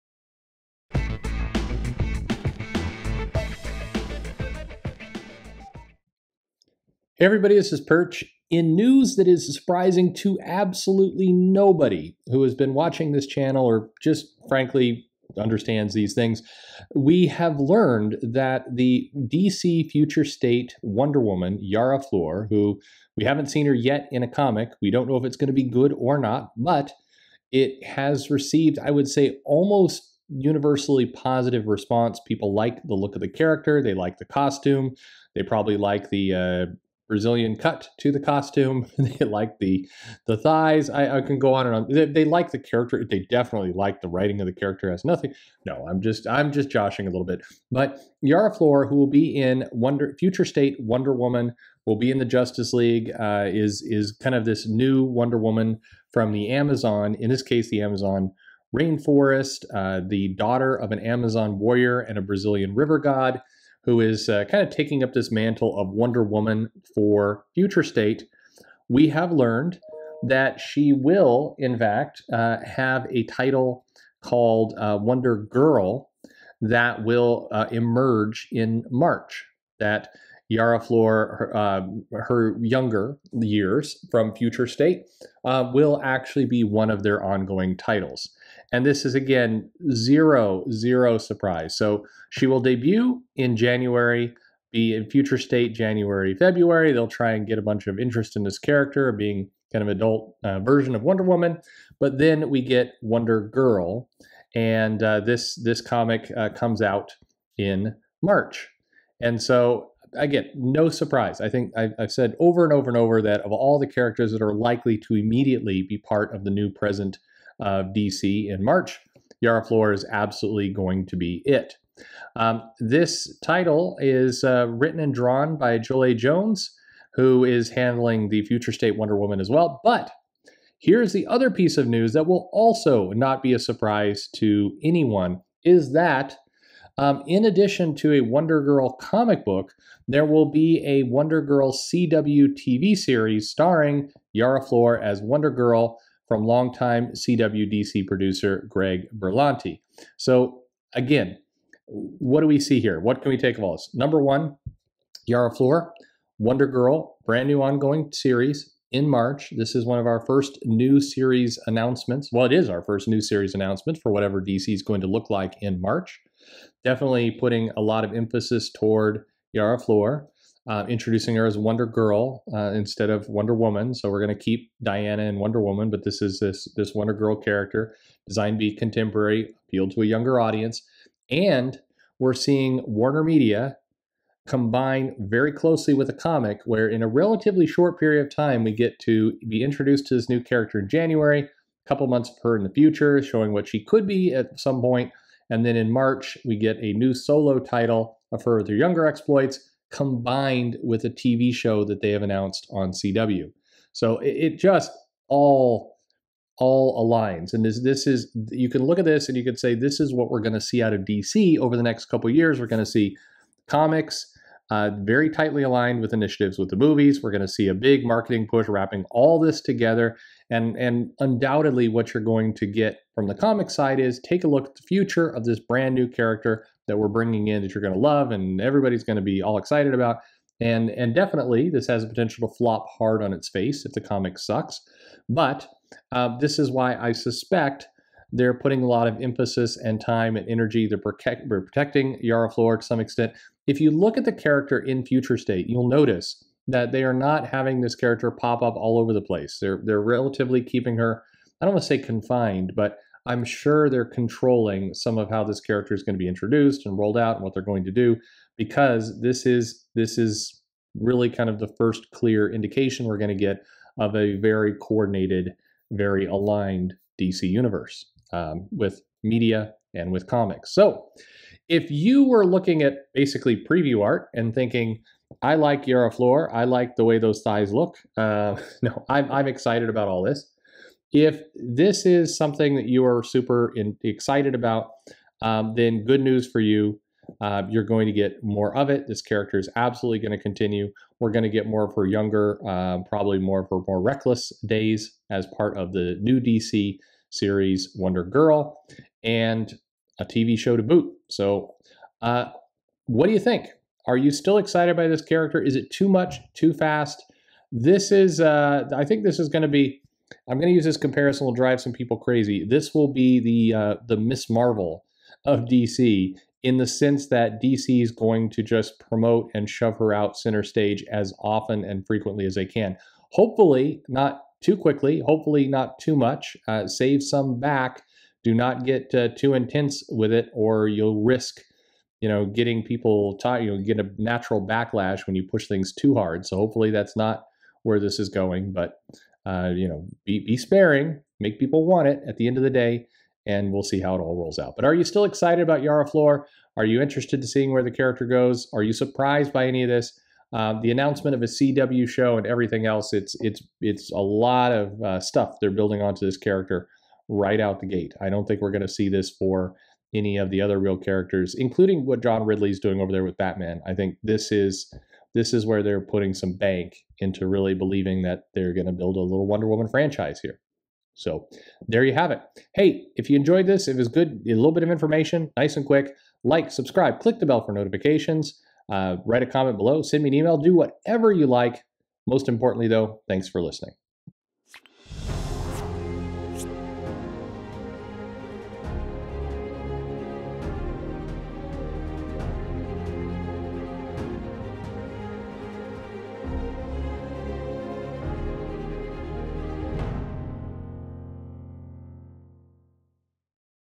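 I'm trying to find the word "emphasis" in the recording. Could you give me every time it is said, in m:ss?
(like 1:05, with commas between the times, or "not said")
2:48, 3:59.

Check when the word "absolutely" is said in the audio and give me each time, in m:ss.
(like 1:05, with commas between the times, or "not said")
0:10, 2:00, 4:49.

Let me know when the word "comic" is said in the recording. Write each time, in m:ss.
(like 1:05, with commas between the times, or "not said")
0:24, 1:45, 2:18, 3:06, 3:33, 3:43, 3:53, 4:30.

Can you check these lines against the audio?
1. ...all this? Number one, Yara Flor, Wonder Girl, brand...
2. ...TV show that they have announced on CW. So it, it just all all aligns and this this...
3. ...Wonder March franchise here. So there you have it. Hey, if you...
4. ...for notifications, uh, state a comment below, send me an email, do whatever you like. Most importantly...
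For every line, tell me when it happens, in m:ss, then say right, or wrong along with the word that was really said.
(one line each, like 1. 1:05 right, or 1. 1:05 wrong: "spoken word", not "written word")
1. 2:33 right
2. 3:21 right
3. 6:09 wrong: "Woman", not "March"
4. 6:17 wrong: "write", not "state".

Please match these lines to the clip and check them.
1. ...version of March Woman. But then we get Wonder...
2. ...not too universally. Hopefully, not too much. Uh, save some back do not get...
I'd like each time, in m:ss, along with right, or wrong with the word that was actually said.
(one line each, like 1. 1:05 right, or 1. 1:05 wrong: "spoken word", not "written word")
1. 1:40 wrong: "Wonder", not "March"
2. 5:24 wrong: "quickly", not "universally".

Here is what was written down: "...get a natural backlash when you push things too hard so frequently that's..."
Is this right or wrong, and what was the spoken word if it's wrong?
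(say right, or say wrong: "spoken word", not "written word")
wrong: "hopefully", not "frequently".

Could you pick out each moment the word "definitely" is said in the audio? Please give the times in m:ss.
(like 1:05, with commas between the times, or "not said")
0:43, 2:46, 3:51.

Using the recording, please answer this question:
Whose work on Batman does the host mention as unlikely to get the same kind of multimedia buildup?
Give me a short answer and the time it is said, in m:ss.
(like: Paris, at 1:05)
John Ridley, at 6:02.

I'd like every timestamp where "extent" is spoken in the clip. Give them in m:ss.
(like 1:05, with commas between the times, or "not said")
4:03.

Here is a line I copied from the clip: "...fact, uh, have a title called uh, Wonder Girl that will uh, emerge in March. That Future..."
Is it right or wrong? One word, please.
wrong.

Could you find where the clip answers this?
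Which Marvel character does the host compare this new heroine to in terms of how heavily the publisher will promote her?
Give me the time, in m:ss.
5:14.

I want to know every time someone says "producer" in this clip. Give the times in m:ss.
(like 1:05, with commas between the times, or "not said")
2:28.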